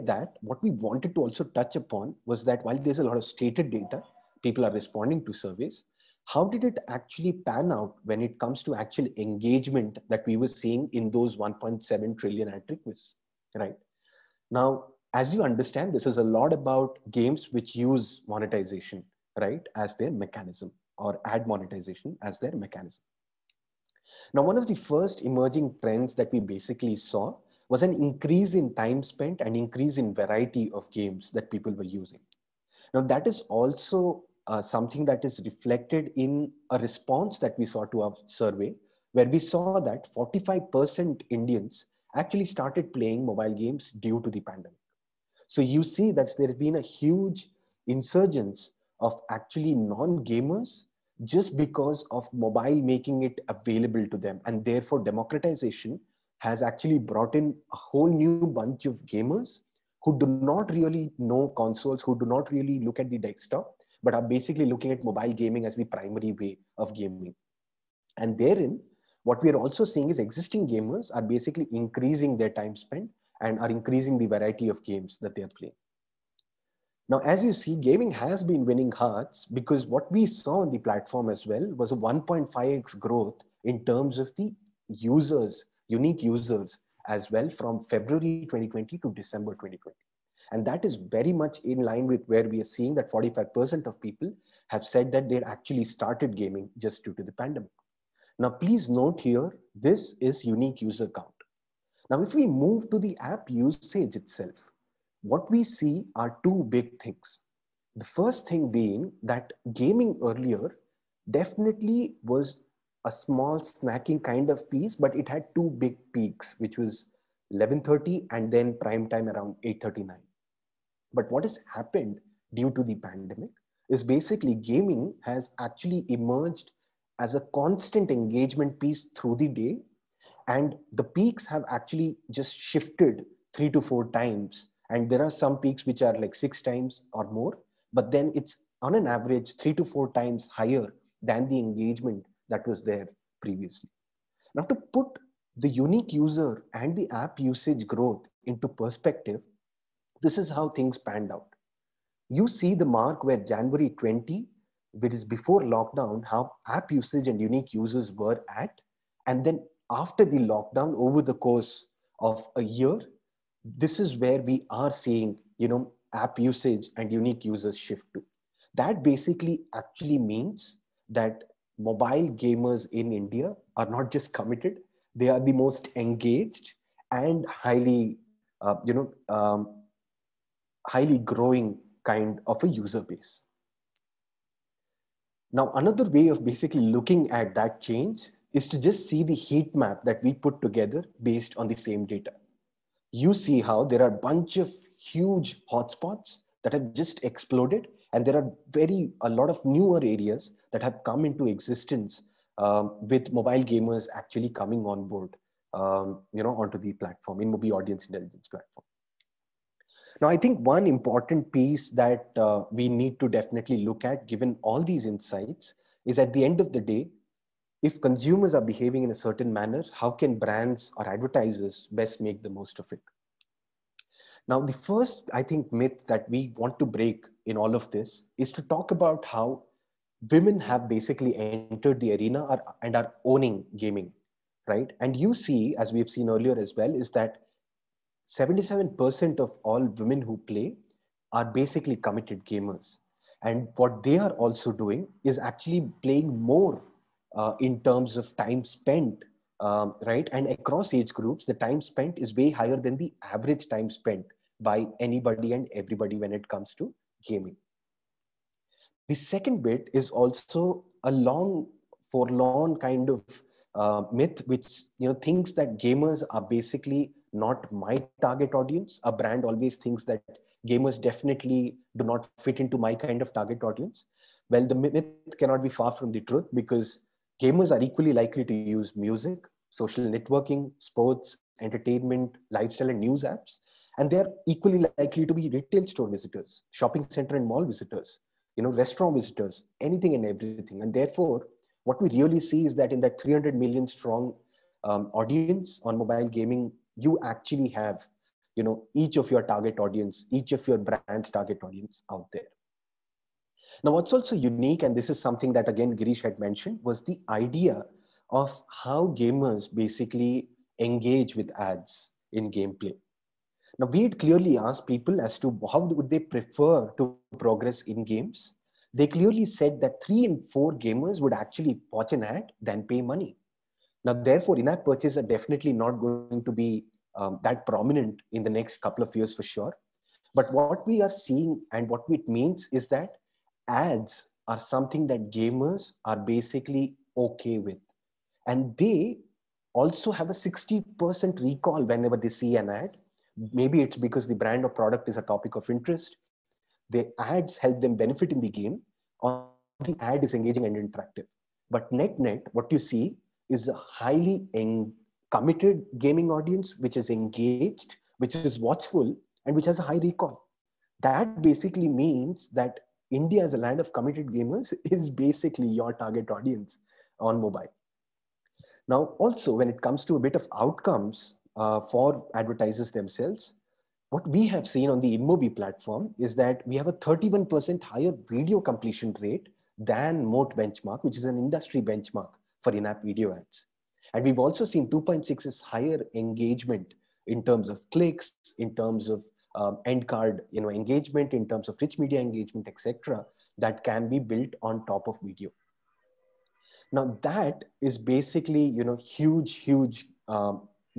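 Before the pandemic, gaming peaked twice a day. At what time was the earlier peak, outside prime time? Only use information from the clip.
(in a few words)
11:30.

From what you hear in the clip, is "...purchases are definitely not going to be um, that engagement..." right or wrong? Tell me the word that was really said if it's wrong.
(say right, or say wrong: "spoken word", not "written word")
wrong: "prominent", not "engagement".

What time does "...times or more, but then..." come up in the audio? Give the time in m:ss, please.
2:16.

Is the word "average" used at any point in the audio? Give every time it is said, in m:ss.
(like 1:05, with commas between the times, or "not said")
2:19, 4:13.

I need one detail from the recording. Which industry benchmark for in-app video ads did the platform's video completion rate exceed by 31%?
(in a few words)
Moat.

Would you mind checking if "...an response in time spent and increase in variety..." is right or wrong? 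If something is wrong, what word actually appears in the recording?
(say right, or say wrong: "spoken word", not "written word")
wrong: "increase", not "response".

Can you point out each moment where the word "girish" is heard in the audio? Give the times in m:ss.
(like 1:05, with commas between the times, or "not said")
5:05.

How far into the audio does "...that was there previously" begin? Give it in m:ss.
2:22.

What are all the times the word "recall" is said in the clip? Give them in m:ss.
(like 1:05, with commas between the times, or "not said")
5:41, 6:00.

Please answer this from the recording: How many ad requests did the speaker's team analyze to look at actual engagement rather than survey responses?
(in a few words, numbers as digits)
1.7 trillion.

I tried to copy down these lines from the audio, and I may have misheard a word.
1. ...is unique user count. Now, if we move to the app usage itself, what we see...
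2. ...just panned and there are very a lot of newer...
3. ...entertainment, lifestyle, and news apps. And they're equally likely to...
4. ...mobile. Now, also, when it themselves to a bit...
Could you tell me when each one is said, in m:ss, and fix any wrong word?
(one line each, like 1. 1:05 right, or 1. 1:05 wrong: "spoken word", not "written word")
1. 1:40 right
2. 3:16 wrong: "exploded", not "panned"
3. 4:41 right
4. 6:07 wrong: "comes", not "themselves".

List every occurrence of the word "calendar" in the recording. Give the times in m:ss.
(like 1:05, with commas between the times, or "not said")
not said.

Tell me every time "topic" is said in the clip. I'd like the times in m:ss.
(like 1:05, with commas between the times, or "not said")
5:45.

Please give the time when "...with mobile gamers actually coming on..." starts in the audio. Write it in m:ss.
3:23.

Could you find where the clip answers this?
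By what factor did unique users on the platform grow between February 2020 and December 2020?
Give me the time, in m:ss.
1:21.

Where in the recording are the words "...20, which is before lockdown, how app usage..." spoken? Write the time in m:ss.
2:33.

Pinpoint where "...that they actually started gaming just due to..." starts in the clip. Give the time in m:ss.
1:35.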